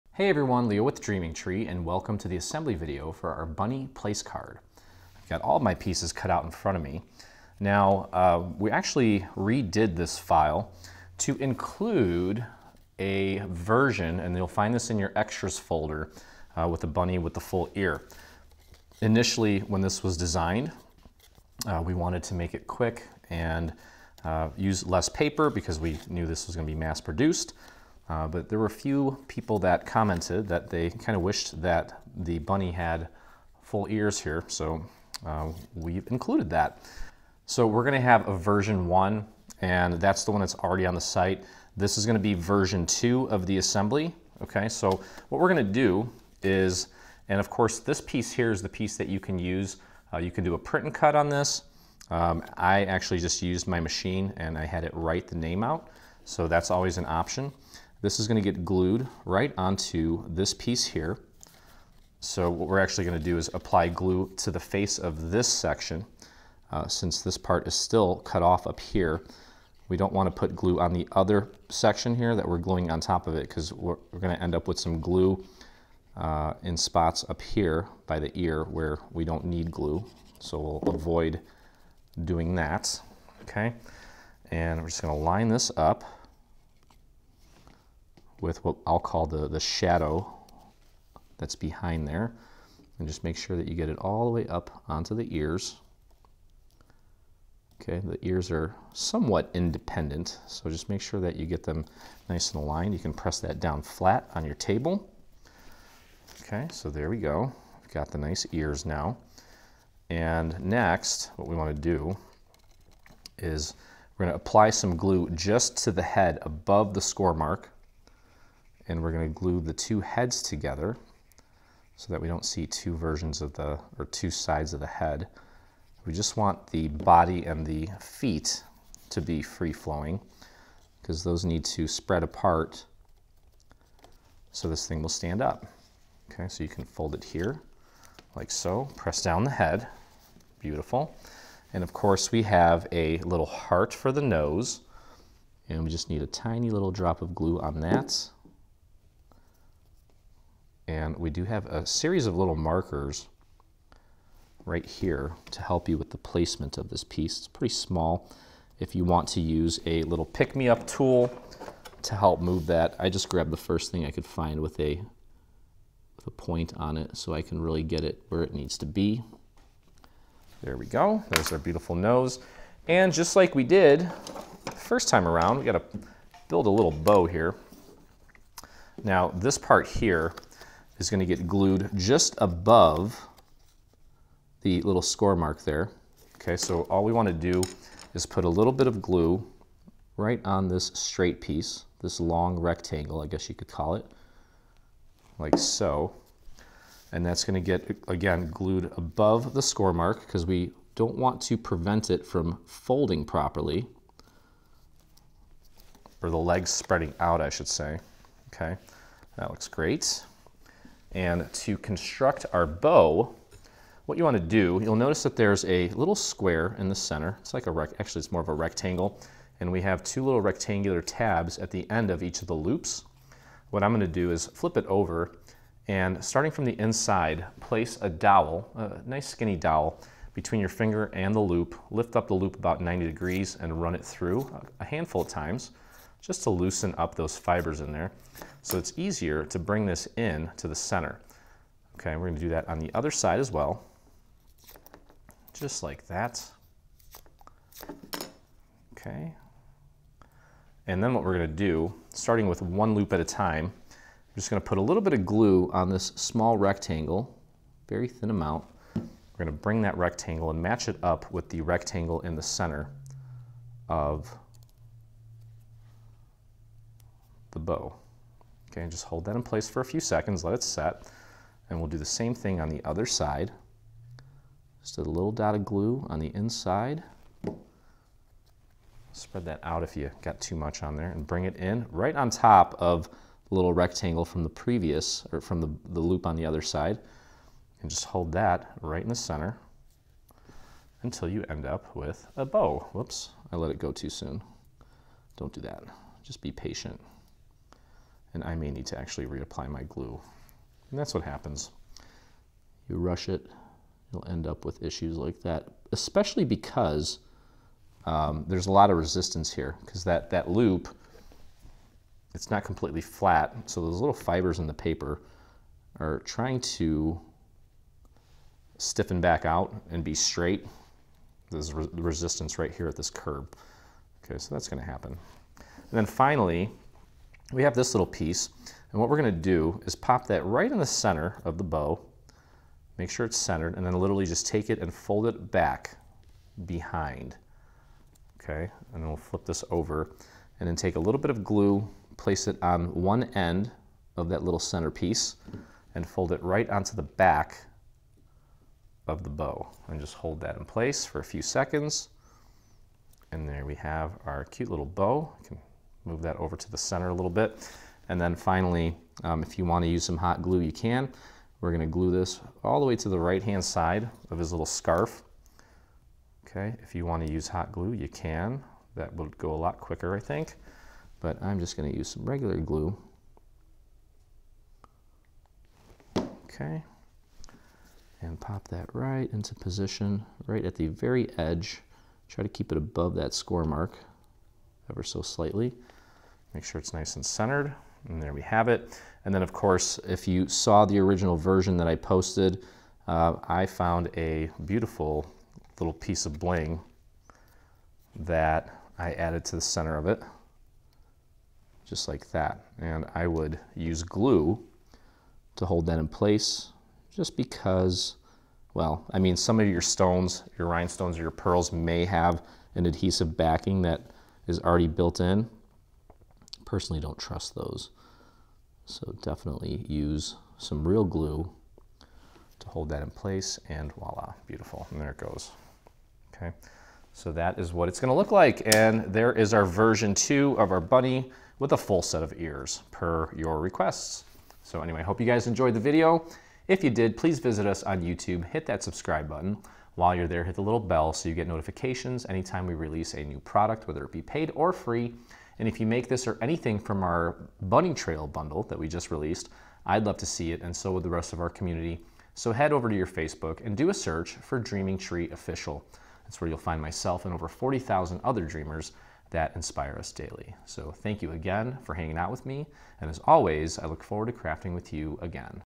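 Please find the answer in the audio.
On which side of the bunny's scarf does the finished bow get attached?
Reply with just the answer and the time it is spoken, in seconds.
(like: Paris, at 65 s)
right-hand side, at 363 s.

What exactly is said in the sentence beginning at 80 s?
So we'll avoid doing that, okay?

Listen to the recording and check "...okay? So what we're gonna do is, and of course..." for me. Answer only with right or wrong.
right.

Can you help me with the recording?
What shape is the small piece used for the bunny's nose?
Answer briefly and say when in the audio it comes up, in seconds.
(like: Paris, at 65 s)
heart, at 143 s.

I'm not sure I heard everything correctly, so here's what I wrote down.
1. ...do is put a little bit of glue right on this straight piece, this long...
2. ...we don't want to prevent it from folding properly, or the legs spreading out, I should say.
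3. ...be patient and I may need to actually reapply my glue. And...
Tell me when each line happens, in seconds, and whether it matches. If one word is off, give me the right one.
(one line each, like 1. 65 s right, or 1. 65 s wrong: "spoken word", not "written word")
1. 187 s right
2. 200 s right
3. 296 s right.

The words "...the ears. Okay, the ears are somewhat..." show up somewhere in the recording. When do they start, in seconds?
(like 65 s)
95 s.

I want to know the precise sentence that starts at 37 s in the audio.
So we're gonna have a version one, and that's the one that's already on the site.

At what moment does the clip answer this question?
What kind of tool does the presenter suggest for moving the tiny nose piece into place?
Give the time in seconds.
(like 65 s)
160 s.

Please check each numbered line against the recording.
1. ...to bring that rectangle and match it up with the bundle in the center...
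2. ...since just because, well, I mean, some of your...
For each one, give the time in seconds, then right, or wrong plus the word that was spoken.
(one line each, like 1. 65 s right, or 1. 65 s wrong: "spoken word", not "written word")
1. 259 s wrong: "rectangle", not "bundle"
2. 406 s wrong: "place", not "since".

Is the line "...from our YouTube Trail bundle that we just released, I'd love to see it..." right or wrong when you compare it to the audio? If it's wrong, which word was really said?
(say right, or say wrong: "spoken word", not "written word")
wrong: "Bunny", not "YouTube".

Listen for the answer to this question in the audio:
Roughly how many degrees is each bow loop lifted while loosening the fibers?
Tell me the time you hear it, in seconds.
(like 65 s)
232 s.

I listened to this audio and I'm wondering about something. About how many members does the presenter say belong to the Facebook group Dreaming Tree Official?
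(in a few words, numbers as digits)
40,000.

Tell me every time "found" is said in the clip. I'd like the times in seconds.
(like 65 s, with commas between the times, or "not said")
393 s.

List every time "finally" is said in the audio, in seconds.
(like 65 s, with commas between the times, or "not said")
326 s, 358 s.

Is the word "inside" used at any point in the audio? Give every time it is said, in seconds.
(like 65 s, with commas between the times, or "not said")
226 s, 276 s.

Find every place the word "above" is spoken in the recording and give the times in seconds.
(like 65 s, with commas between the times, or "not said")
116 s, 182 s, 198 s, 382 s.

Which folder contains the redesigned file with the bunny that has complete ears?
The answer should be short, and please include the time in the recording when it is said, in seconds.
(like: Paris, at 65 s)
extras folder, at 15 s.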